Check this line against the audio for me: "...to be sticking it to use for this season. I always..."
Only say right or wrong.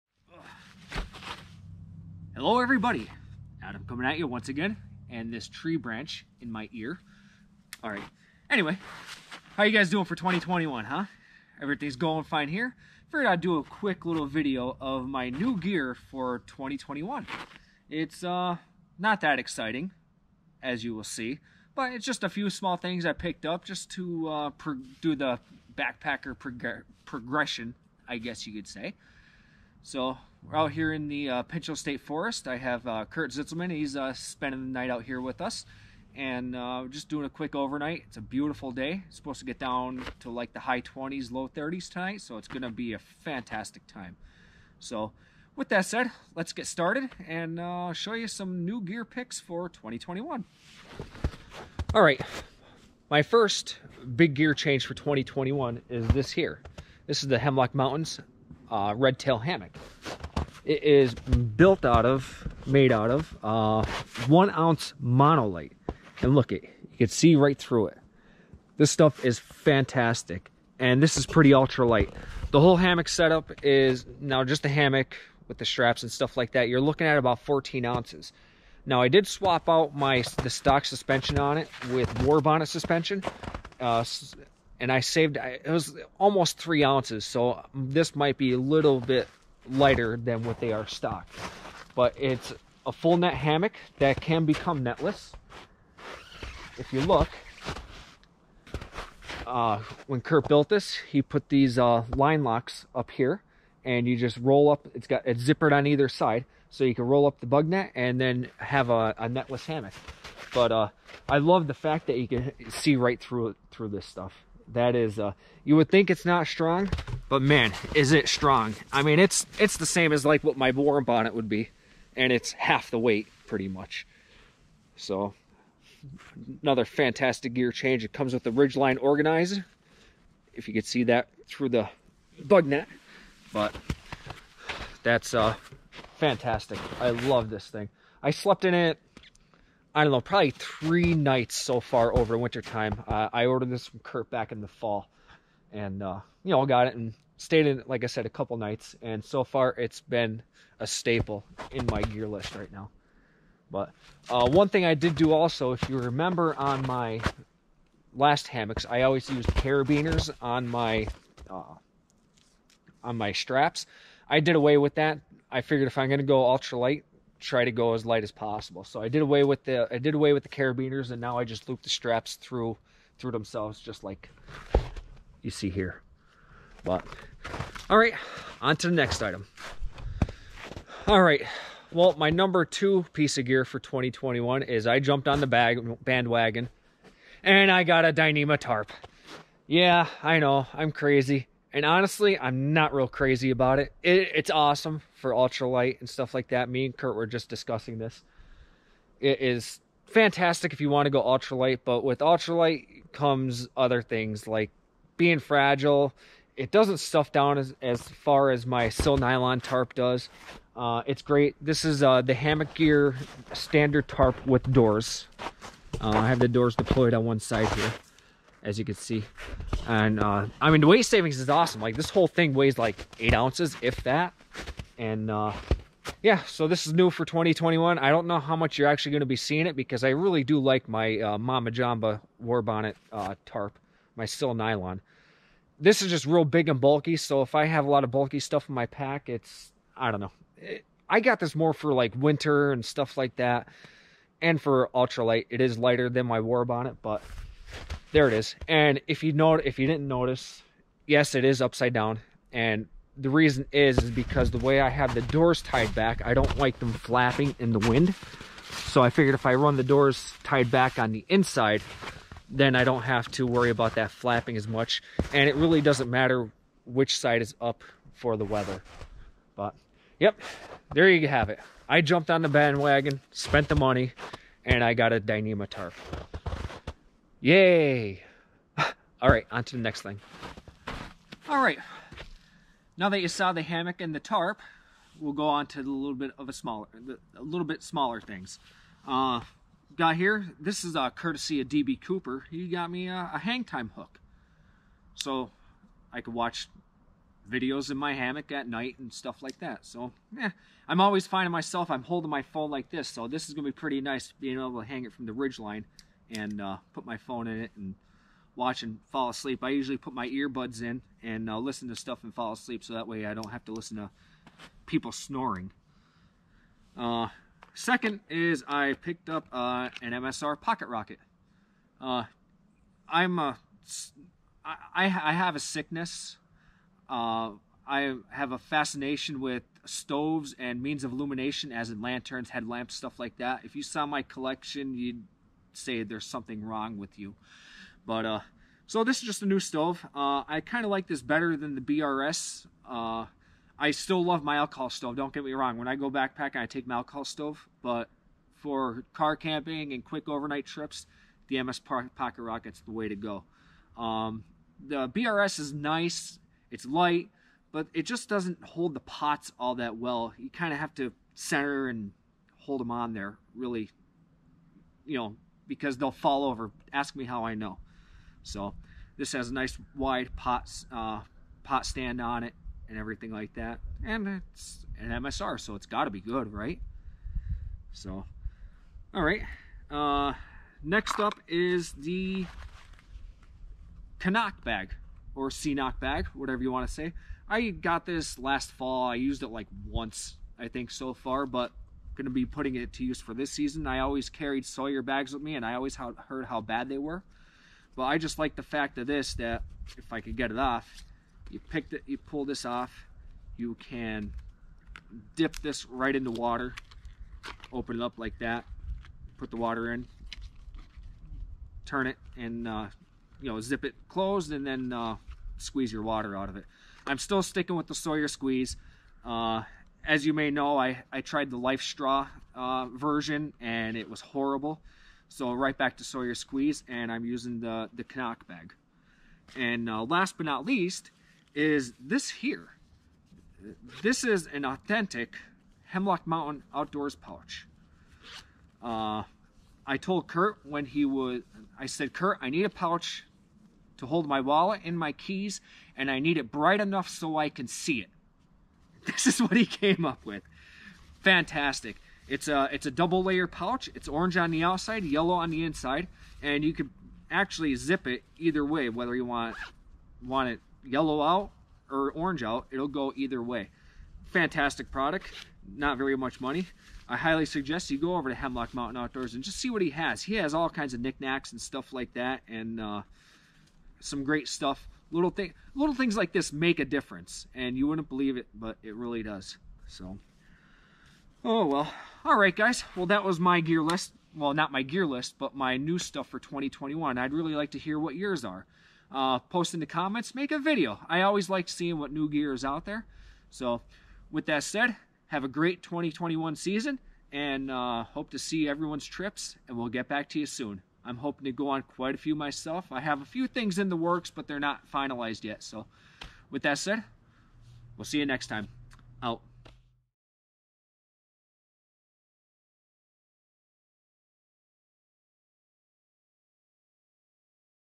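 wrong.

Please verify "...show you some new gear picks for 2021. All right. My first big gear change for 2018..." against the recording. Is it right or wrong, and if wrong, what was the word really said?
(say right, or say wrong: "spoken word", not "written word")
wrong: "2021", not "2018".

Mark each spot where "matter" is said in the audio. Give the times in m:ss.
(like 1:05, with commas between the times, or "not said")
4:26.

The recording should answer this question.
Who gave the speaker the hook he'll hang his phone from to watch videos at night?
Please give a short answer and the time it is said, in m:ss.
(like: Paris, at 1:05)
DB Cooper, at 4:51.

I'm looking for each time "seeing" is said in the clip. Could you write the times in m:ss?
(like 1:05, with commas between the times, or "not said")
3:49, 8:11.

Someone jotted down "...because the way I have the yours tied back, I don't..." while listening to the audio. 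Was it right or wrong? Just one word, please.
wrong.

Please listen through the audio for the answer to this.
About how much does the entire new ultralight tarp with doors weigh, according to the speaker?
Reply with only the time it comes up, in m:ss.
3:43.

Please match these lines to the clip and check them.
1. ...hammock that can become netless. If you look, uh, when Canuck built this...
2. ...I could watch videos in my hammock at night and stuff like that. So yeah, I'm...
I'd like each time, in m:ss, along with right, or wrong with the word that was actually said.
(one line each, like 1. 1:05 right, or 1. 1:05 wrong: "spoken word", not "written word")
1. 1:33 wrong: "Kurt", not "Canuck"
2. 4:56 right.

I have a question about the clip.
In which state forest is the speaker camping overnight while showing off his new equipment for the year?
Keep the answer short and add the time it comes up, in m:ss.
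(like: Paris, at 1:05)
Pinchot State Forest, at 0:31.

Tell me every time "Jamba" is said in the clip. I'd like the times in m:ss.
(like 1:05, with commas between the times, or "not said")
3:51.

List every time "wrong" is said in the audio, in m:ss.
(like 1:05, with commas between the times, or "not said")
5:36, 5:45.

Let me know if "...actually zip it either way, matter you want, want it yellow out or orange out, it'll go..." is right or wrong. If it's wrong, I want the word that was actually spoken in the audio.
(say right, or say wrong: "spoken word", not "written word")
wrong: "whether", not "matter".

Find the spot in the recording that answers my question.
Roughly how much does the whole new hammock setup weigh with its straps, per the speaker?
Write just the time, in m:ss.
1:17.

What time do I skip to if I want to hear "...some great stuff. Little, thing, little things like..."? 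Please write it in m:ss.
7:53.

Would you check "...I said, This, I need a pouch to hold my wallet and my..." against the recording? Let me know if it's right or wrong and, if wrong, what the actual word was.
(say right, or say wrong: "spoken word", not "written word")
wrong: "Kurt", not "This".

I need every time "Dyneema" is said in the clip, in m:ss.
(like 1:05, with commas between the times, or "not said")
3:08, 4:35.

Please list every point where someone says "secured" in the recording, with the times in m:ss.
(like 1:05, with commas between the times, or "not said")
not said.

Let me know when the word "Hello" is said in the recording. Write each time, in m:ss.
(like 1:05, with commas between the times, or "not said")
0:02.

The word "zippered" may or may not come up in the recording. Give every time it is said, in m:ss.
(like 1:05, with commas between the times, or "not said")
1:45.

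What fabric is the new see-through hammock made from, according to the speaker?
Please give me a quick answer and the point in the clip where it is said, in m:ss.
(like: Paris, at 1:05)
one ounce monolite, at 1:04.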